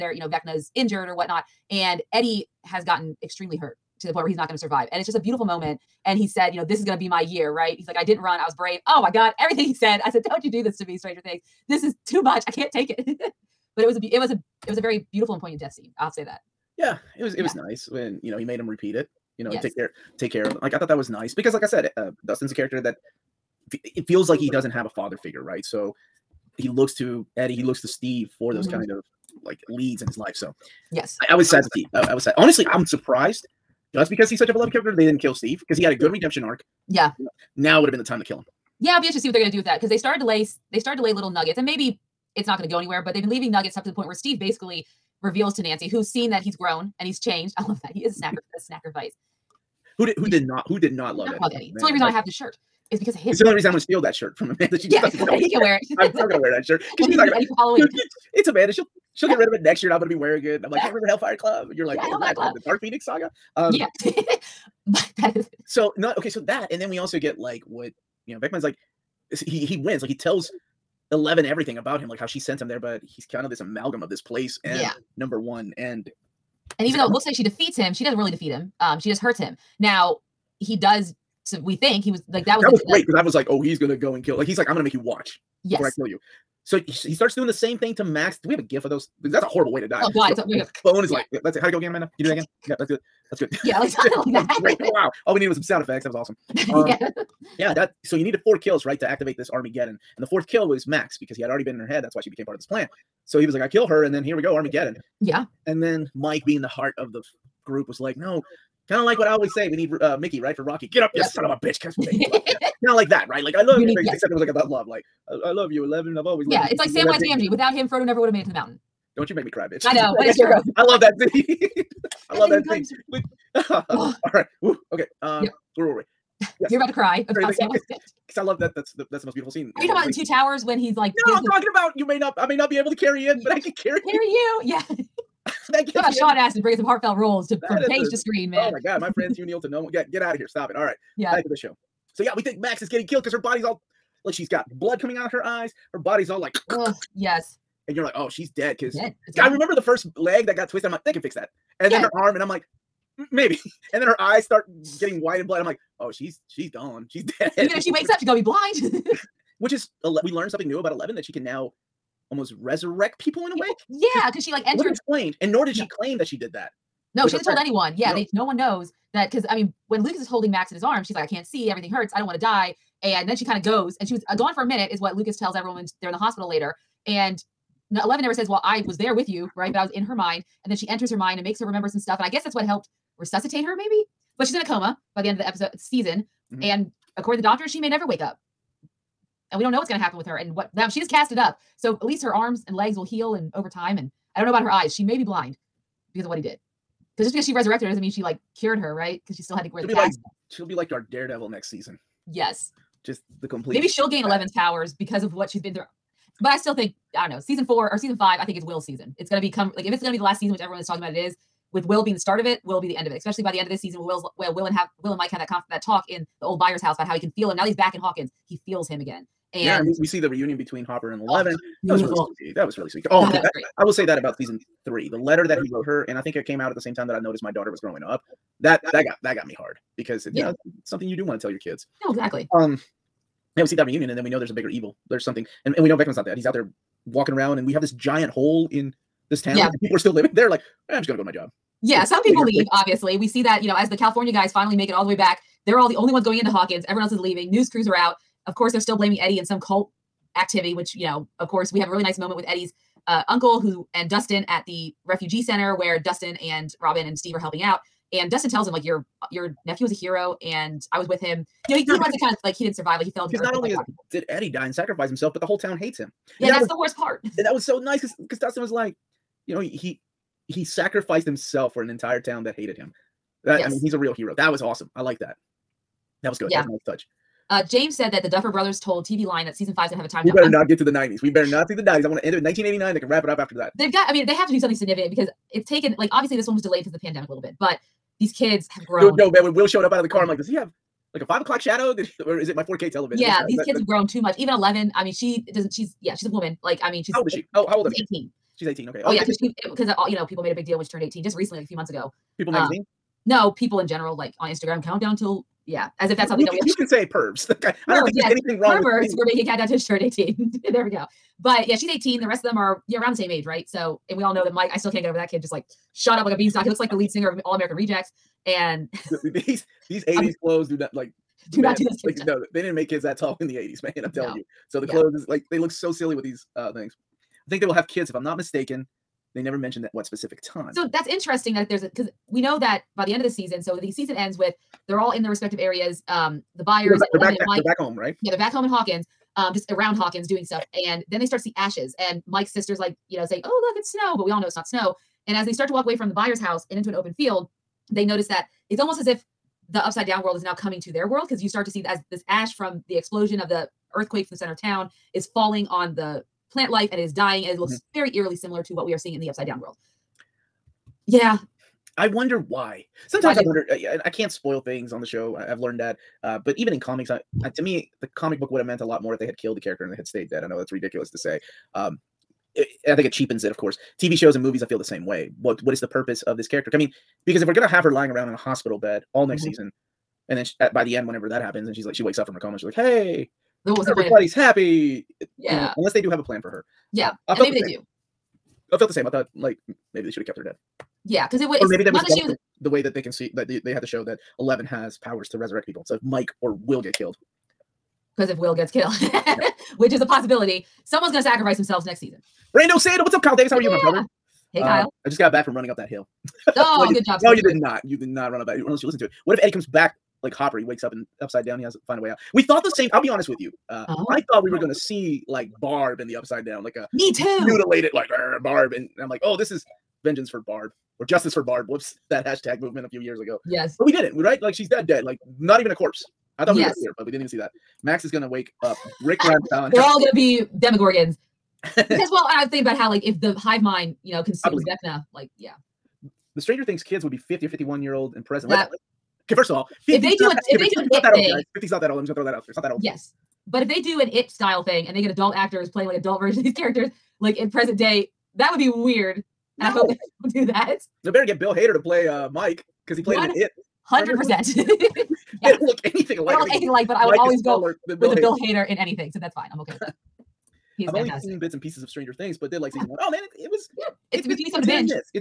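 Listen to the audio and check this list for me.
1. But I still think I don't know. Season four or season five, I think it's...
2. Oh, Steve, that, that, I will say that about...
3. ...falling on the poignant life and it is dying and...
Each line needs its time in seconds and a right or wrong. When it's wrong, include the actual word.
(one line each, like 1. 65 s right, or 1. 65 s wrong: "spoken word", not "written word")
1. 206 s right
2. 223 s wrong: "God", not "Steve"
3. 355 s wrong: "plant", not "poignant".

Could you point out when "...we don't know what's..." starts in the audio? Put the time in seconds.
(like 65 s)
189 s.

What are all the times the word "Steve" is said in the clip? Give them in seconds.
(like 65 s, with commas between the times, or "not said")
27 s, 35 s, 44 s, 257 s.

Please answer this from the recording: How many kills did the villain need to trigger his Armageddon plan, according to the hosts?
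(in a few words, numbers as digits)
4.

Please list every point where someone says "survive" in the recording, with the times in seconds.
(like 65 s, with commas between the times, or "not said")
4 s, 262 s.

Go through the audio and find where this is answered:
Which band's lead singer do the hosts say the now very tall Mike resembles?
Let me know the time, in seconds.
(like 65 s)
317 s.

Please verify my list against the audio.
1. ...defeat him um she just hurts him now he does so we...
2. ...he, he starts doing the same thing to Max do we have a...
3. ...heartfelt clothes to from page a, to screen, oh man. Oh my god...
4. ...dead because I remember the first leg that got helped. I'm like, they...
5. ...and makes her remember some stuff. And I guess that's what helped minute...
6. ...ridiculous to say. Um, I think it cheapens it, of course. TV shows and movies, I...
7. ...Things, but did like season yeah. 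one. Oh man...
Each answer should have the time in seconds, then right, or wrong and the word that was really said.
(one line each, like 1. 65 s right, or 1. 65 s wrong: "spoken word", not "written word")
1. 78 s right
2. 86 s right
3. 136 s wrong: "roles", not "clothes"
4. 148 s wrong: "twisted", not "helped"
5. 181 s wrong: "resuscitate", not "minute"
6. 370 s right
7. 462 s right.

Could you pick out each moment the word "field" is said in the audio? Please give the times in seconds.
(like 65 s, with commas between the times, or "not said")
347 s.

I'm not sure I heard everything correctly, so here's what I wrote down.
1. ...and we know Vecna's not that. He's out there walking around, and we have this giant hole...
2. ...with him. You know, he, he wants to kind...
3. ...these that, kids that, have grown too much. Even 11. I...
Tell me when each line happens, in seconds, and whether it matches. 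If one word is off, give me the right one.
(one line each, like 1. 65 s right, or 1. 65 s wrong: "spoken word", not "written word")
1. 235 s right
2. 261 s right
3. 293 s right.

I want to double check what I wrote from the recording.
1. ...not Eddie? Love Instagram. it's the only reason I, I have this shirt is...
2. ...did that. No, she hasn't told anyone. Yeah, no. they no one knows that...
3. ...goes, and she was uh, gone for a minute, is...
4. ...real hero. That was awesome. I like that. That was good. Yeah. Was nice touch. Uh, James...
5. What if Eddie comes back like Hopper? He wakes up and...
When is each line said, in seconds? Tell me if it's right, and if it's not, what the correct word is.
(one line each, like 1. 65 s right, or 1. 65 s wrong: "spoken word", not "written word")
1. 51 s wrong: "Eddie", not "Instagram"
2. 166 s right
3. 173 s right
4. 273 s right
5. 409 s right.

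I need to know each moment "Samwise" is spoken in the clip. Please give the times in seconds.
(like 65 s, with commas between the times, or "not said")
116 s.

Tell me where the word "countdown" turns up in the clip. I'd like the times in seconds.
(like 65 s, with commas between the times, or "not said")
304 s, 309 s.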